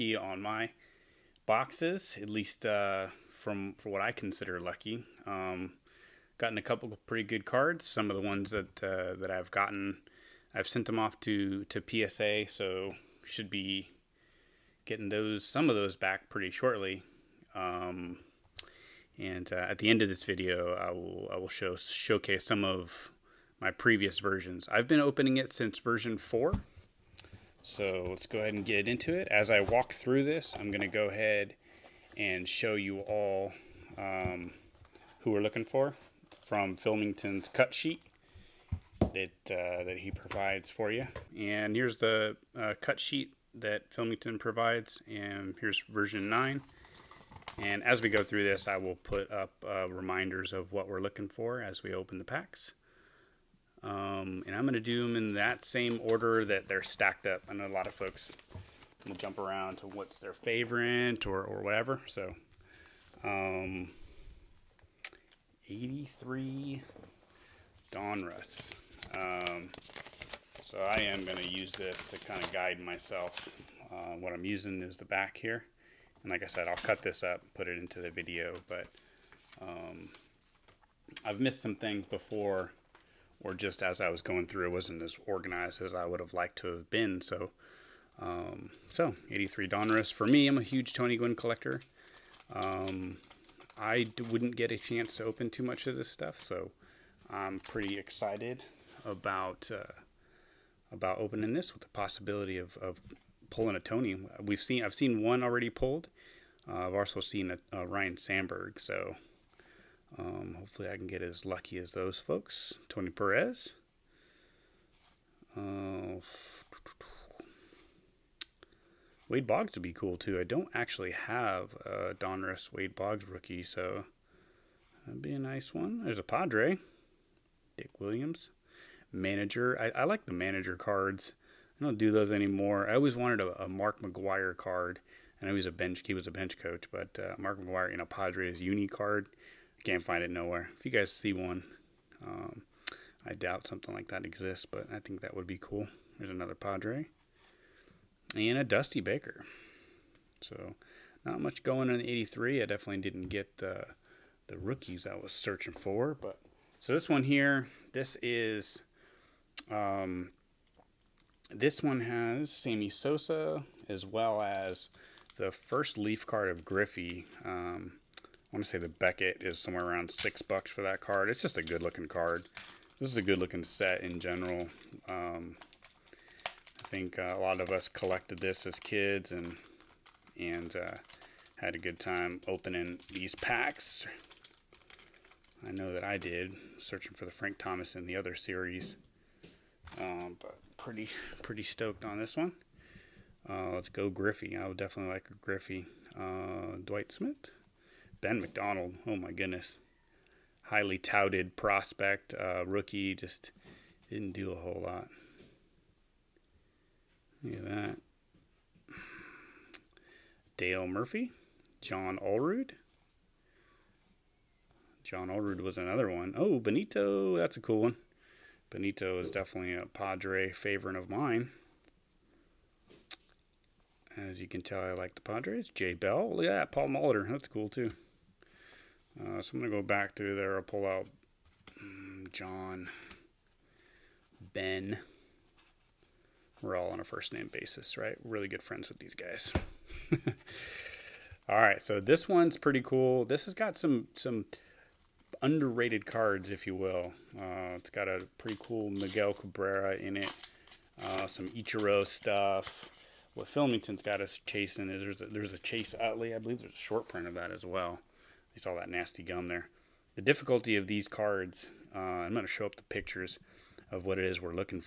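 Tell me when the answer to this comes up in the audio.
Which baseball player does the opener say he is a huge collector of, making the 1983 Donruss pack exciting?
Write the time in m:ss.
1:30.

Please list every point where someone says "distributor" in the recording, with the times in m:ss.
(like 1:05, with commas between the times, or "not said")
not said.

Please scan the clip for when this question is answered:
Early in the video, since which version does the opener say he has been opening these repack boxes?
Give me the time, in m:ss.
0:25.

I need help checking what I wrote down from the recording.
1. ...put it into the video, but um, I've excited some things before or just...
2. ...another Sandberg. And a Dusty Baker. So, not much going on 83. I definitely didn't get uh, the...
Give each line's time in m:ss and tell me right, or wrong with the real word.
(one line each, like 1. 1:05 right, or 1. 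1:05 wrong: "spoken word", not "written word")
1. 1:17 wrong: "missed", not "excited"
2. 2:26 wrong: "Padre", not "Sandberg".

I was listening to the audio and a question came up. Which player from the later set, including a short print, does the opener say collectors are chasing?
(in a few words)
Chase Utley.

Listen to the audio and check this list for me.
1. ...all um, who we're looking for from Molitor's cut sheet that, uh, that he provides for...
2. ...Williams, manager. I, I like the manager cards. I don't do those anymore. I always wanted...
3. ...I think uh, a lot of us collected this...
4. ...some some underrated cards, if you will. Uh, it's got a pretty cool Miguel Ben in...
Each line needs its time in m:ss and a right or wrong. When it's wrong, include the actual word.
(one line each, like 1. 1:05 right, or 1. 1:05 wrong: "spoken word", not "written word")
1. 0:32 wrong: "Filmington", not "Molitor"
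2. 2:07 right
3. 2:56 right
4. 4:03 wrong: "Cabrera", not "Ben".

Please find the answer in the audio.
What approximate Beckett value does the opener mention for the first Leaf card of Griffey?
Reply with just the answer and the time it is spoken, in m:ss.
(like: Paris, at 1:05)
$6, at 2:50.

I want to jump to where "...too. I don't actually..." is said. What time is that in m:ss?
2:00.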